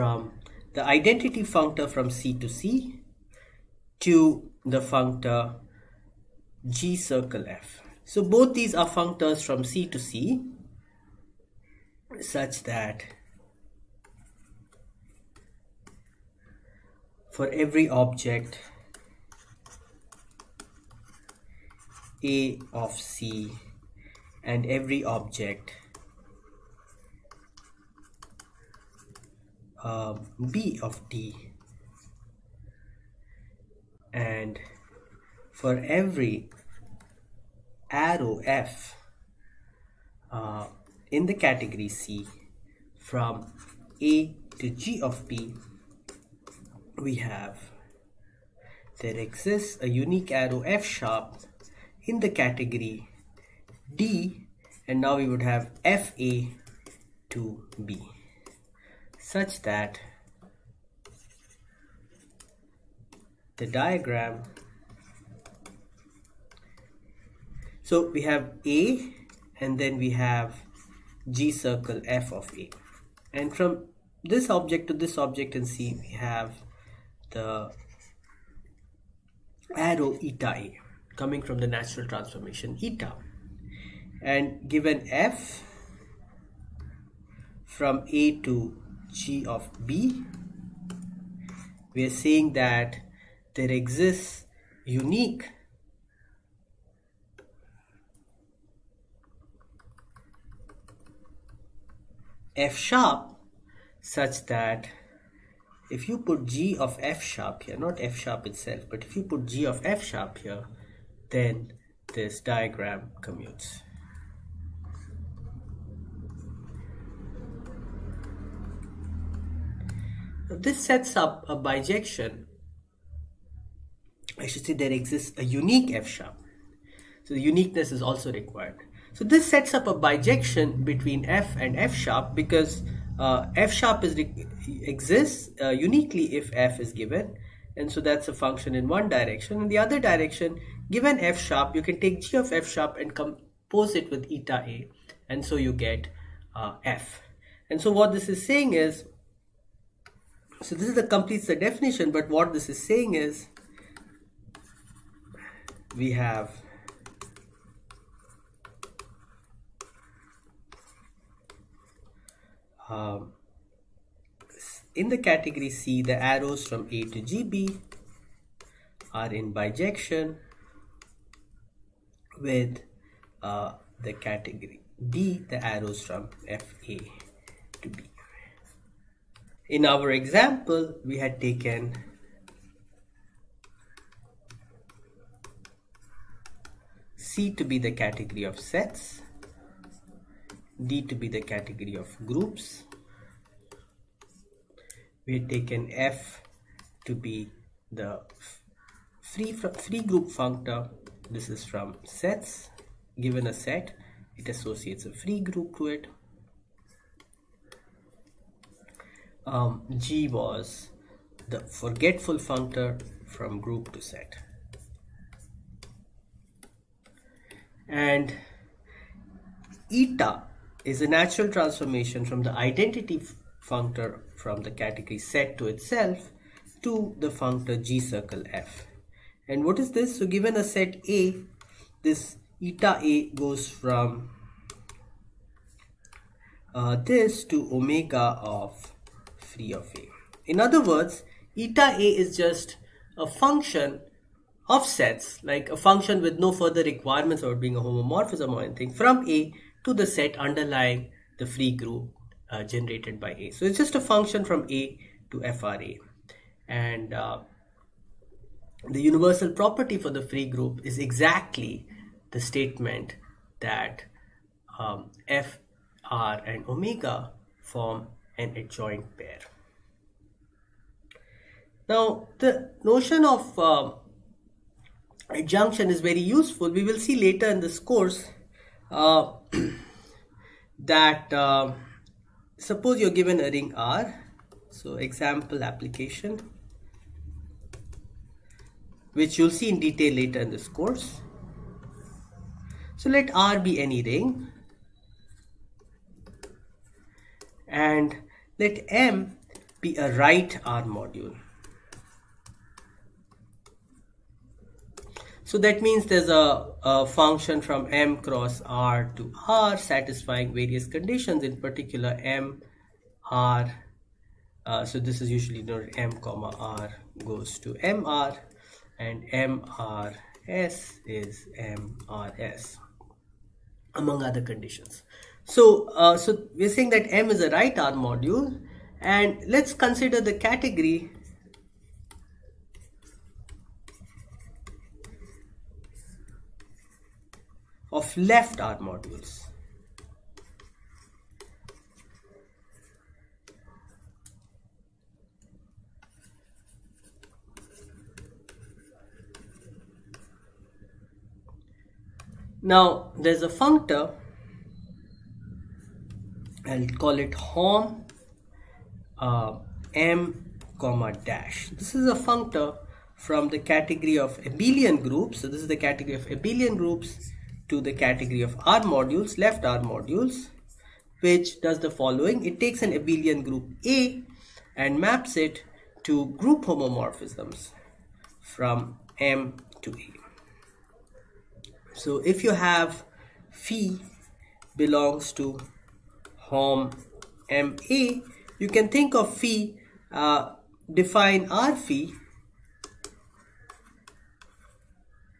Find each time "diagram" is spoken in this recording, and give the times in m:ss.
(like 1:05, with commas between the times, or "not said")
1:03, 1:52.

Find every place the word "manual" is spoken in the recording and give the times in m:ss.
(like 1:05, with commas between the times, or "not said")
not said.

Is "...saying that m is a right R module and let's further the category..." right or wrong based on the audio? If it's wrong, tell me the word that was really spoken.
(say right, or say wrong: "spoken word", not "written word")
wrong: "consider", not "further".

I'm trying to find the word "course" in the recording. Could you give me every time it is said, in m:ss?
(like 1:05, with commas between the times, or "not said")
4:37, 4:50.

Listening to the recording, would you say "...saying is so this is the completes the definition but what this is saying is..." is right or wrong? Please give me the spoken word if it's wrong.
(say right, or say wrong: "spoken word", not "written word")
right.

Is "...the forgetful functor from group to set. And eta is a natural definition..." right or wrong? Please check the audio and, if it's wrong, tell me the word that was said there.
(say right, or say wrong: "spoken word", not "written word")
wrong: "transformation", not "definition".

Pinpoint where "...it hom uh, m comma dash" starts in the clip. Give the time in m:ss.
5:57.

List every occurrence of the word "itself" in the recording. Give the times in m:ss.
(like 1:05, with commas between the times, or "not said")
1:48, 3:45.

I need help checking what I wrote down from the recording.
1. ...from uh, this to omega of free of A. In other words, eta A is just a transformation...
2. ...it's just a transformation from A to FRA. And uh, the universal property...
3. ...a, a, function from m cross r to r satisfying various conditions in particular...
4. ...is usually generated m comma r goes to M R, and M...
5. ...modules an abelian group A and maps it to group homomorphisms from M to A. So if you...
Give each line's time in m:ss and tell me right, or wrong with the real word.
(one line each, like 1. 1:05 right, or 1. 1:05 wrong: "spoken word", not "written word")
1. 3:53 wrong: "function", not "transformation"
2. 4:13 wrong: "function", not "transformation"
3. 5:06 right
4. 5:15 wrong: "denoted", not "generated"
5. 6:12 wrong: "takes", not "modules".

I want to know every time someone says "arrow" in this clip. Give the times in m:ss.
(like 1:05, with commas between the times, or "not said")
0:37, 0:50, 1:19, 2:46, 2:55.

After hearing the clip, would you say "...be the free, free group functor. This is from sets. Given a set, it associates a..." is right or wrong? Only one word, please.
right.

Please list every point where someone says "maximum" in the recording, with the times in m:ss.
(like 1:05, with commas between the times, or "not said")
not said.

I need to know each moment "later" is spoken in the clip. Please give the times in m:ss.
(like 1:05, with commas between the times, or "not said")
4:37, 4:50.